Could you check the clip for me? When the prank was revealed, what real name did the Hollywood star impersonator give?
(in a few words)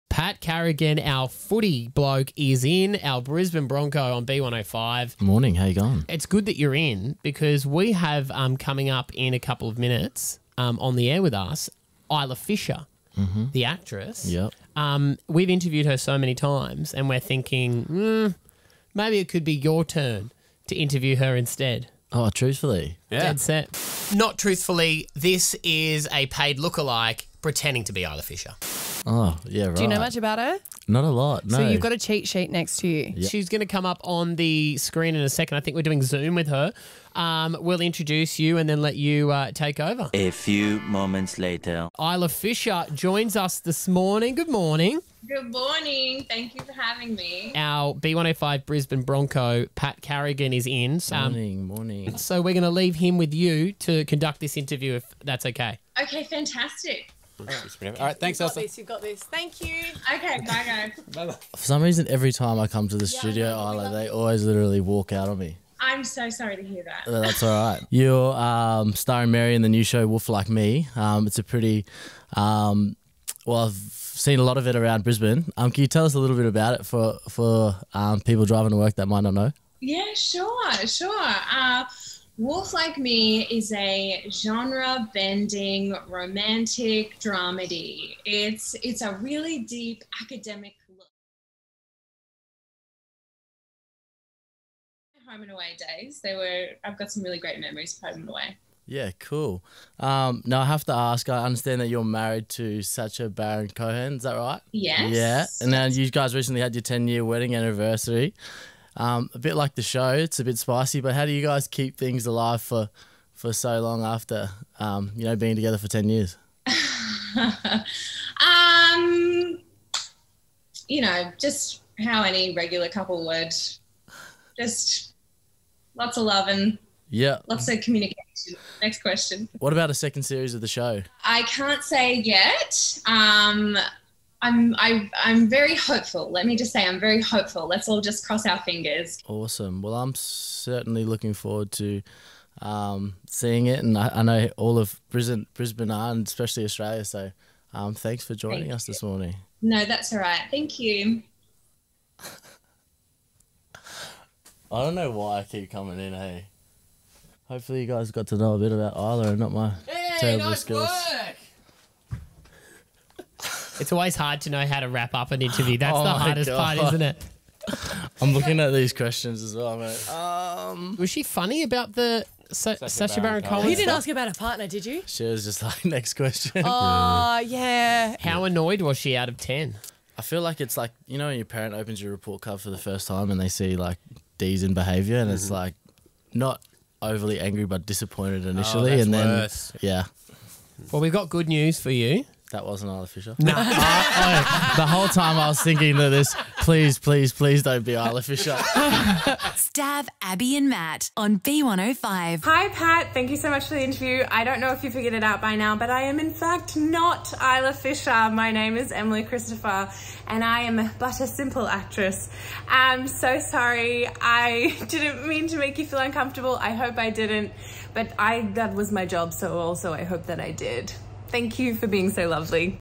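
Emily Christopher.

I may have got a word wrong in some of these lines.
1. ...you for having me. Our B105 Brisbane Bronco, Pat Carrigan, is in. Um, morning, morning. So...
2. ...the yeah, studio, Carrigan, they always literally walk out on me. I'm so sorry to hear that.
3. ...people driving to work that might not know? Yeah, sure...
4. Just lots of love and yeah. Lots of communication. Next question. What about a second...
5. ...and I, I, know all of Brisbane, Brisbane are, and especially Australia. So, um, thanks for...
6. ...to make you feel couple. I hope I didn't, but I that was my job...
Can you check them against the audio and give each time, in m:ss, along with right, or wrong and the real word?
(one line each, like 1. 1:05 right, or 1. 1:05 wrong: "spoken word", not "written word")
1. 0:46 right
2. 1:02 wrong: "Isla", not "Carrigan"
3. 1:18 right
4. 2:04 right
5. 2:23 right
6. 3:35 wrong: "uncomfortable", not "couple".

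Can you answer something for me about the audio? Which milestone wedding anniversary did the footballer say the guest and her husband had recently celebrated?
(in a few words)
10 year.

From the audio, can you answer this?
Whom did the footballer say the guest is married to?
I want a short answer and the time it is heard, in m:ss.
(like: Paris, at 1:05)
Sacha Baron Cohen, at 1:42.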